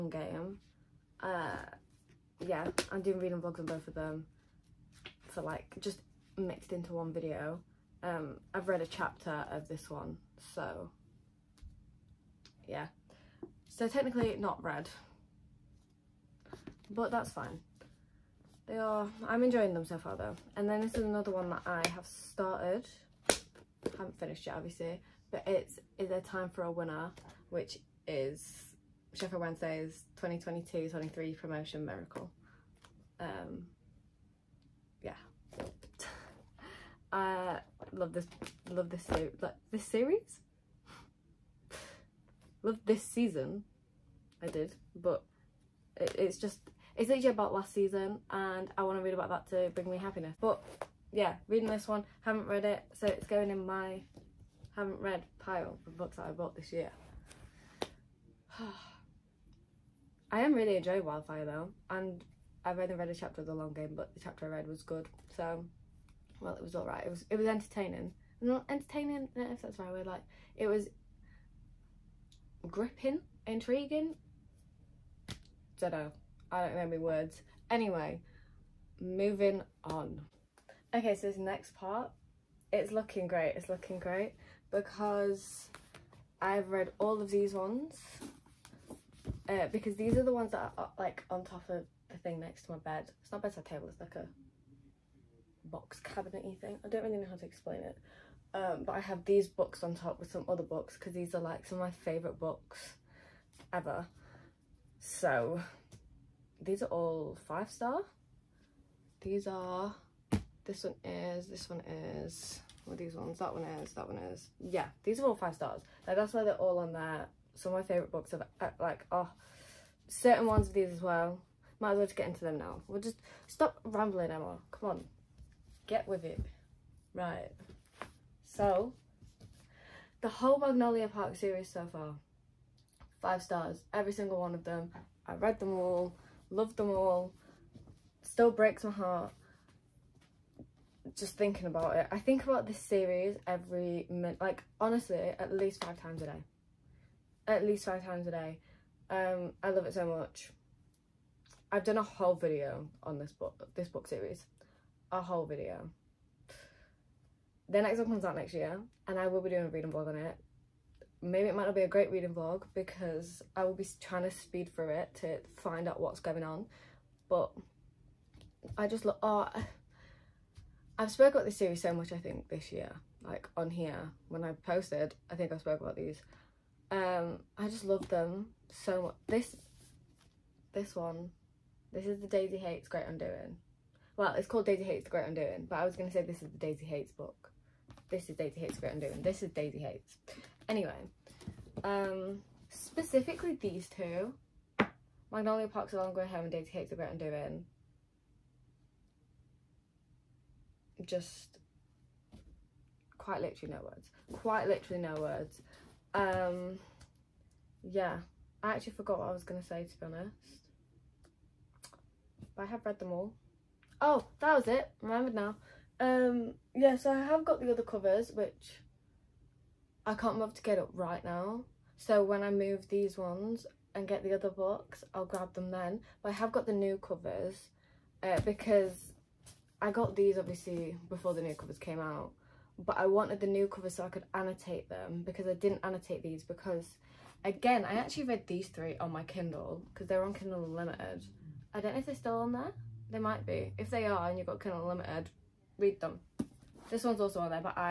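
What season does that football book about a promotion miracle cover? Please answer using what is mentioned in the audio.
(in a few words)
2022-23.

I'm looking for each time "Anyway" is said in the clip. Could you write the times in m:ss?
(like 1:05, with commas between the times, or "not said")
1:17, 3:10.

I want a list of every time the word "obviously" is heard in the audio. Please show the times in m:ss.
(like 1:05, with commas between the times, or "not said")
0:24, 3:50.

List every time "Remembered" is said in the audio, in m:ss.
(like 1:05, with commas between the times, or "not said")
3:35.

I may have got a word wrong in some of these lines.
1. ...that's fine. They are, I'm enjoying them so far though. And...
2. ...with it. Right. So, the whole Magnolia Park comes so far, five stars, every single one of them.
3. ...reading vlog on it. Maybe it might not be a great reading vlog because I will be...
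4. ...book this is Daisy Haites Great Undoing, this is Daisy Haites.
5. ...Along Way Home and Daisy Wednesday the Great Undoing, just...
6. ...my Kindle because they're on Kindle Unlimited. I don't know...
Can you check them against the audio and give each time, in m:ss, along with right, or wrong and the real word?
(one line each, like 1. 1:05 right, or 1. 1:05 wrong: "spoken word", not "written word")
1. 0:17 right
2. 2:06 wrong: "series", not "comes"
3. 2:39 right
4. 3:07 right
5. 3:15 wrong: "Haites", not "Wednesday"
6. 3:59 right.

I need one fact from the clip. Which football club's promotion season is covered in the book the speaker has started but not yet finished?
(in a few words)
Sheffield Wednesday.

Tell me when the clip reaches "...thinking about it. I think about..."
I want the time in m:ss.
2:21.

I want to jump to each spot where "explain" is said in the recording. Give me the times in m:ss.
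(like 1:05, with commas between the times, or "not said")
1:37.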